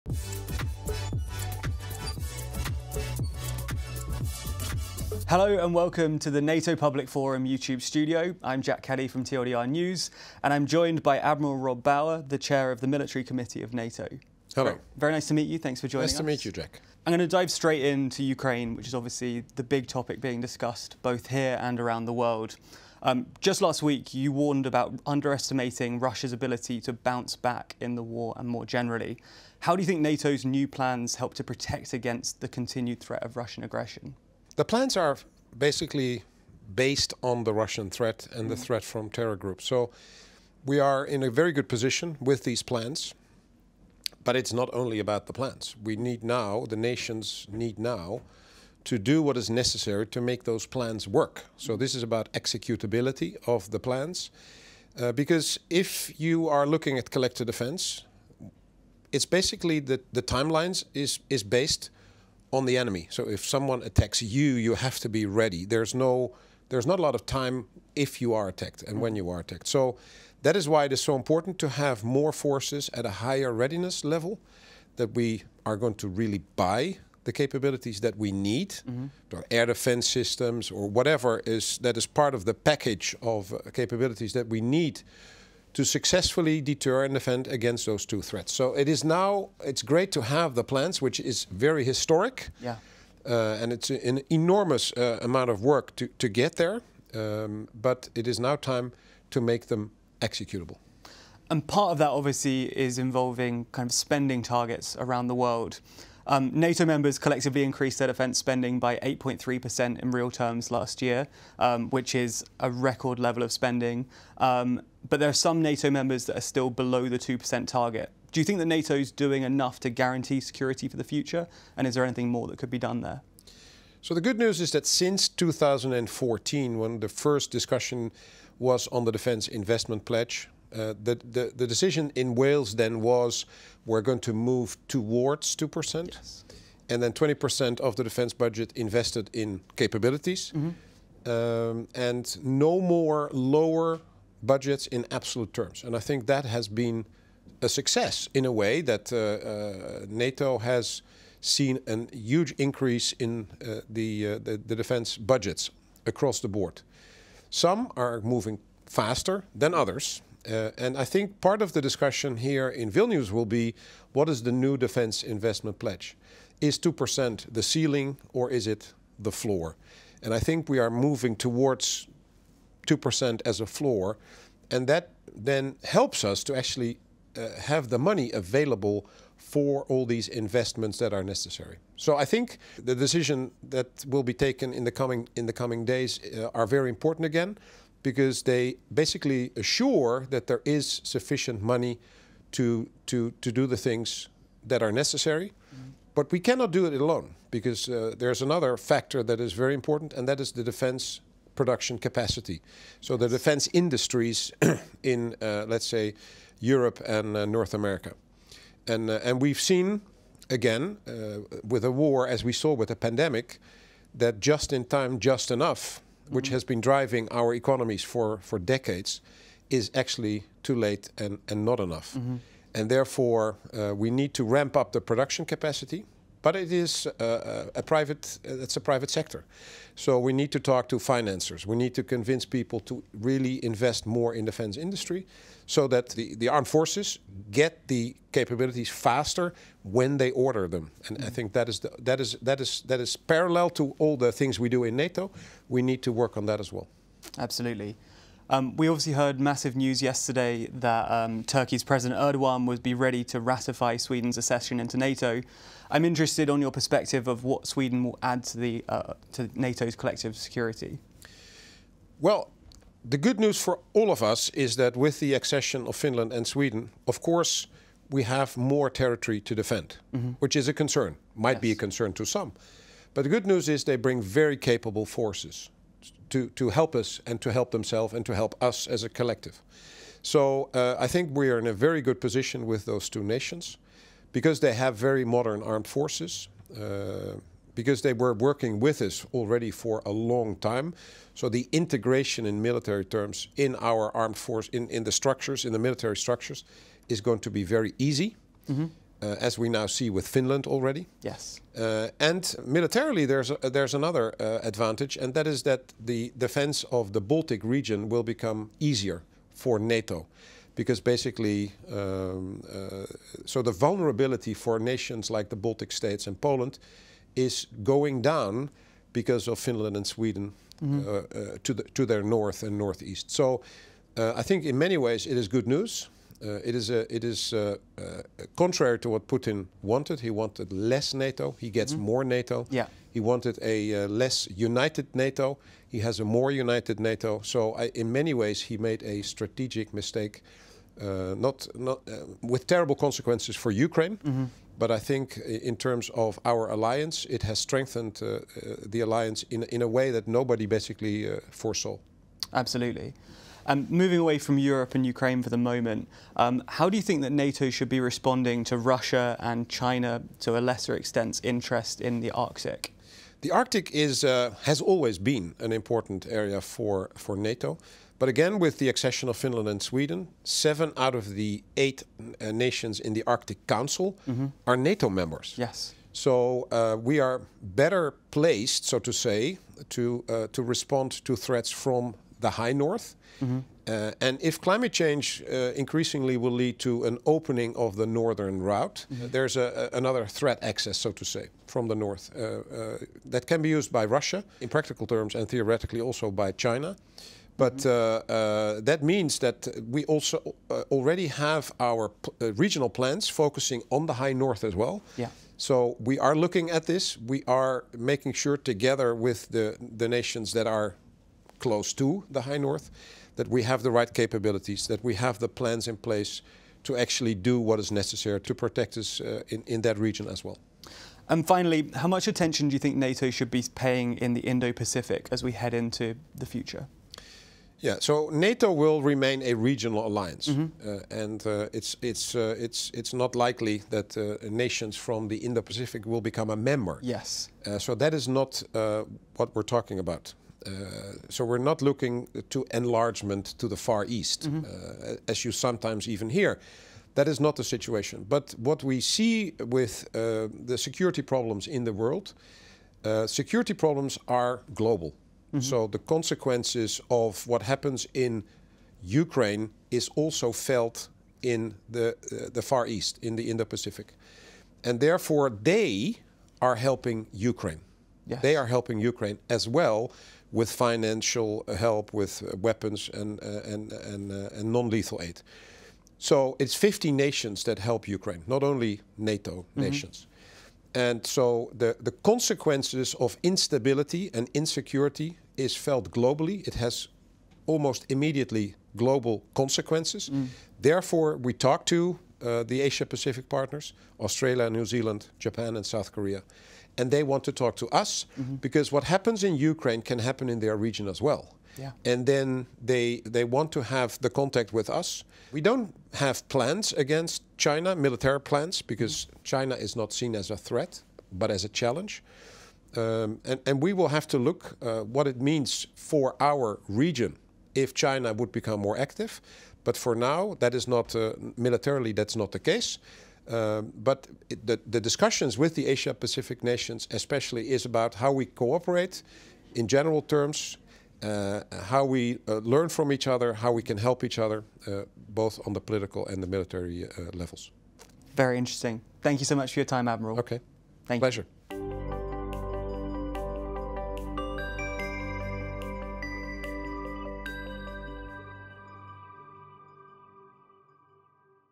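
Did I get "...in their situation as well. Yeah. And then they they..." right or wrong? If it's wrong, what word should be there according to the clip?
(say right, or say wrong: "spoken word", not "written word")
wrong: "region", not "situation".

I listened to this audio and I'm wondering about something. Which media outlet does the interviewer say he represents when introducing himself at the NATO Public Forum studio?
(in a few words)
TLDR News.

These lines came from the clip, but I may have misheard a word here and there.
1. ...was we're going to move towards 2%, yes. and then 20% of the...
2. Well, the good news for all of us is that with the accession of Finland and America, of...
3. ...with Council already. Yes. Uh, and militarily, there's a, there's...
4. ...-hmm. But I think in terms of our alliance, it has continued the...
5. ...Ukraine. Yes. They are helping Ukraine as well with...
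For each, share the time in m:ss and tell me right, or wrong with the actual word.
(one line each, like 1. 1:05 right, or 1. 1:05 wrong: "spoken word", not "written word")
1. 2:13 right
2. 4:22 wrong: "Sweden", not "America"
3. 5:00 wrong: "Finland", not "Council"
4. 5:44 wrong: "strengthened", not "continued"
5. 7:47 right.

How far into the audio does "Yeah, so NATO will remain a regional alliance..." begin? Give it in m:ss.
7:07.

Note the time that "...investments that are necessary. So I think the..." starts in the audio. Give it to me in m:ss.
3:00.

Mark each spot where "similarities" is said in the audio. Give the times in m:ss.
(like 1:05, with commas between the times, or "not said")
not said.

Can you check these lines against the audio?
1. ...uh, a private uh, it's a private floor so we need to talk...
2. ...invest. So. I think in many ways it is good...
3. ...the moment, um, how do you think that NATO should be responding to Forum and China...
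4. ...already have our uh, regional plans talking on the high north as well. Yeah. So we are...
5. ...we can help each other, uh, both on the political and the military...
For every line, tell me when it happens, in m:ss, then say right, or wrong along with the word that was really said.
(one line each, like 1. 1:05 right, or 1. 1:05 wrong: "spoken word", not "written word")
1. 3:47 wrong: "sector", not "floor"
2. 5:22 wrong: "northeast", not "invest"
3. 5:55 wrong: "Russia", not "Forum"
4. 6:40 wrong: "focusing", not "talking"
5. 8:53 right.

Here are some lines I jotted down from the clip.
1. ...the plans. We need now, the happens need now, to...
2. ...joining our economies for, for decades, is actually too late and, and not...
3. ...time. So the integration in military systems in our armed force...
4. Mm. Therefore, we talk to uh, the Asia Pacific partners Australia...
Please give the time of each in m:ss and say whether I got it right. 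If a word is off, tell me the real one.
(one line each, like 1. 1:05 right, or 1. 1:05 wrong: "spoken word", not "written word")
1. 0:45 wrong: "nations", not "happens"
2. 3:36 wrong: "driving", not "joining"
3. 4:50 wrong: "terms", not "systems"
4. 8:10 right.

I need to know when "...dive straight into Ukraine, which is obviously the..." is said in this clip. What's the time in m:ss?
0:17.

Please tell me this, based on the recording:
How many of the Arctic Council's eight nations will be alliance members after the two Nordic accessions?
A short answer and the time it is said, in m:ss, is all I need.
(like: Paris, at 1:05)
7, at 6:10.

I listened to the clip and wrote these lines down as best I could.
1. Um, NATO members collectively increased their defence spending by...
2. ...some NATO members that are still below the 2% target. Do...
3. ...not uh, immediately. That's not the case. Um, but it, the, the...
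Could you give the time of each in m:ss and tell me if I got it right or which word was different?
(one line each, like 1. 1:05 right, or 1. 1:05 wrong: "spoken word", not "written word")
1. 1:46 right
2. 1:55 right
3. 8:40 wrong: "militarily", not "immediately".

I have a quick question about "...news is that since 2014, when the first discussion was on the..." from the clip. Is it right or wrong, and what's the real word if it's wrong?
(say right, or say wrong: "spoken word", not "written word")
right.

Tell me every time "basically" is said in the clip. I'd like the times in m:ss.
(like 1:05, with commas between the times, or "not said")
0:35, 0:59, 3:08, 5:11, 5:50.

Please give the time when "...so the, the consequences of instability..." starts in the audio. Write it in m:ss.
8:01.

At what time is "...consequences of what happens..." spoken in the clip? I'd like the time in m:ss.
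7:36.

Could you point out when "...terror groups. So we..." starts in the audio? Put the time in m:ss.
0:39.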